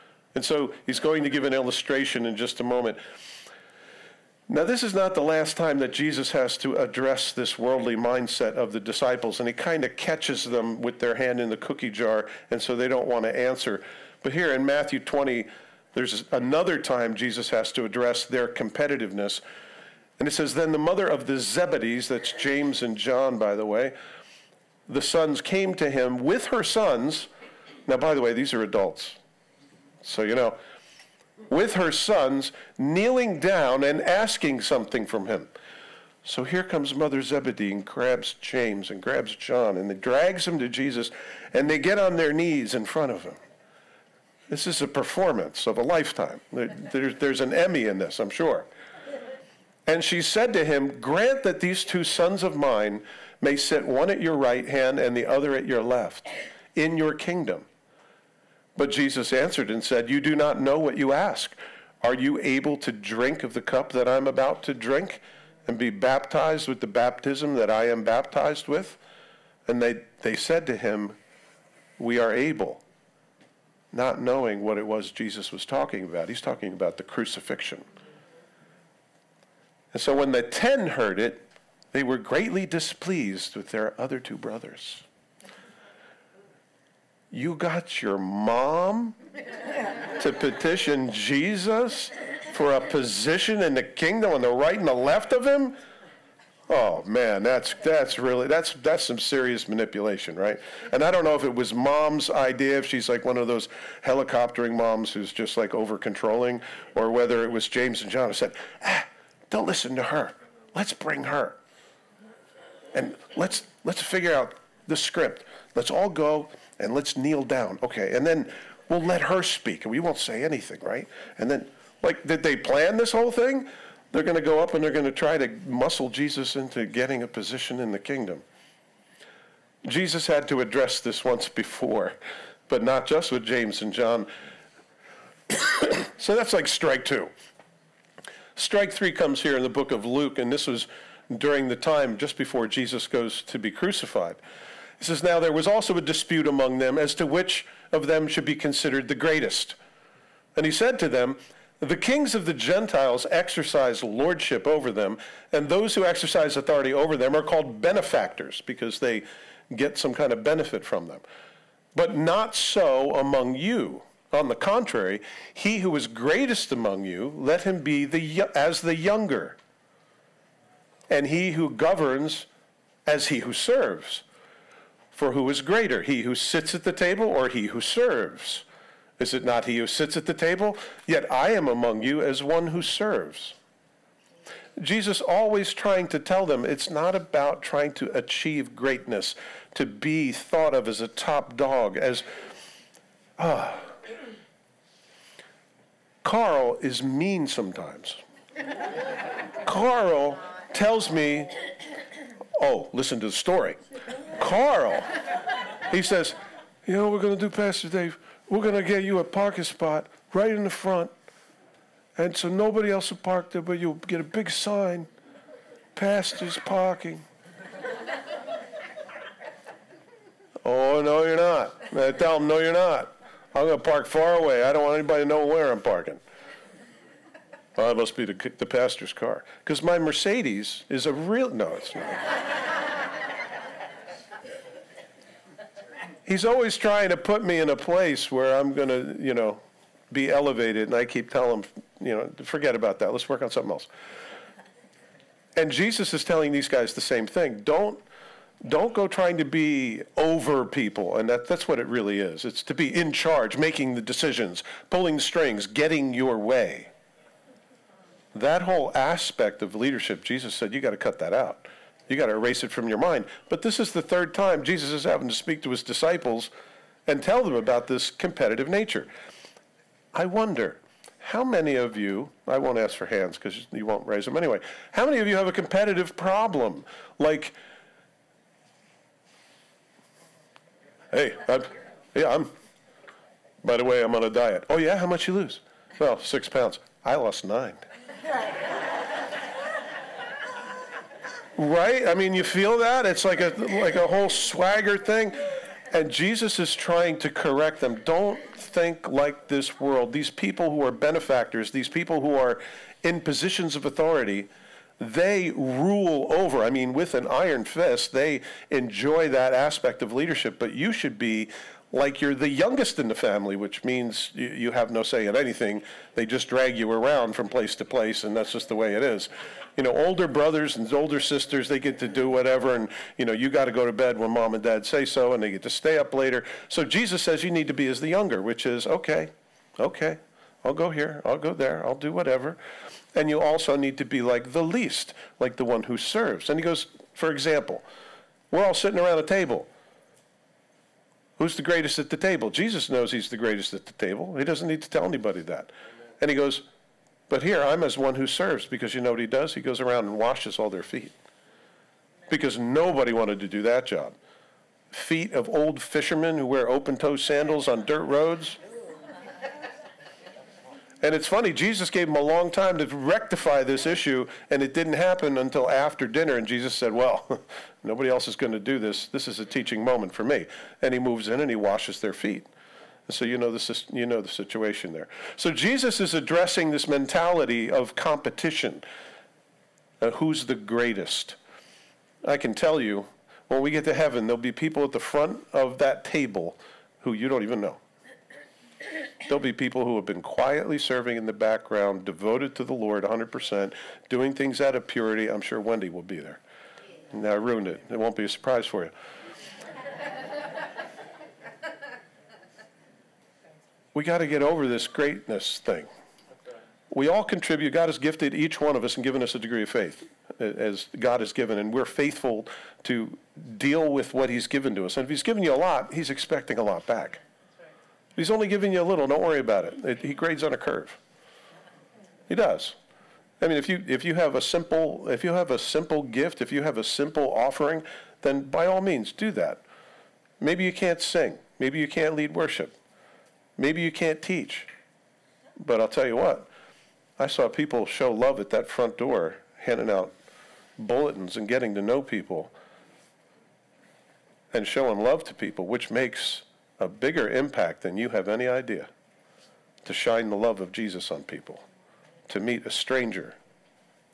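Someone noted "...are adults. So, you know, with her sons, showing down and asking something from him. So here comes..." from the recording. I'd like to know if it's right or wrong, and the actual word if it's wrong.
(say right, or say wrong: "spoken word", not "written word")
wrong: "kneeling", not "showing".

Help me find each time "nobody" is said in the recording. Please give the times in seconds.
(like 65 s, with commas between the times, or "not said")
212 s, 352 s, 367 s.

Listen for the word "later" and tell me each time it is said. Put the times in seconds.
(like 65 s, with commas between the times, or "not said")
326 s.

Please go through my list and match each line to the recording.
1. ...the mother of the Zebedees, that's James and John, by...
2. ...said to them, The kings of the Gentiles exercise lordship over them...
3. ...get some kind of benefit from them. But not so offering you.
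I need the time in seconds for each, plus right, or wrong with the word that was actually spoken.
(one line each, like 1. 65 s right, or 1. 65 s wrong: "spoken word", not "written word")
1. 20 s right
2. 150 s right
3. 159 s wrong: "among", not "offering".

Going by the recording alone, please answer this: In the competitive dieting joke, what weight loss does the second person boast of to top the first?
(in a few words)
9 pounds.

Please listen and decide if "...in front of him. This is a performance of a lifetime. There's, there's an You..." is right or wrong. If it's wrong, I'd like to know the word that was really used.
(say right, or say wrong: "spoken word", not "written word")
wrong: "Emmy", not "You".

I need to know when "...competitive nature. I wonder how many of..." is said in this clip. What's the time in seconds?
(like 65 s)
268 s.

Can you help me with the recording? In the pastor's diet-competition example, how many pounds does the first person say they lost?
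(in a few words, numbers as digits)
6.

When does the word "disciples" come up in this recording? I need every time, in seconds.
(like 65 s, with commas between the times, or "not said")
8 s, 265 s.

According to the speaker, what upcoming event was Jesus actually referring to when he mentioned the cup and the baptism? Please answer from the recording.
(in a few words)
The crucifixion.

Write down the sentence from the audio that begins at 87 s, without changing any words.
You got your mom to petition Jesus for a position in the kingdom on the right and the left of him?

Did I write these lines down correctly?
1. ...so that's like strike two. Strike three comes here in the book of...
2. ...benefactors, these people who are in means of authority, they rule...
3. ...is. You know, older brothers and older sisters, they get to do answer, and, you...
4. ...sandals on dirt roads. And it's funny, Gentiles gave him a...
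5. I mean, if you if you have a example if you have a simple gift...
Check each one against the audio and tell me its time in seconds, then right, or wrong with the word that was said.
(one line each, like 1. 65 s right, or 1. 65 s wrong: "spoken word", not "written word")
1. 136 s right
2. 300 s wrong: "positions", not "means"
3. 319 s wrong: "whatever", not "answer"
4. 357 s wrong: "Jesus", not "Gentiles"
5. 423 s wrong: "simple", not "example".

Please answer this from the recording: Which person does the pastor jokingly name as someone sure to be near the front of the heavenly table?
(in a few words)
Wendy.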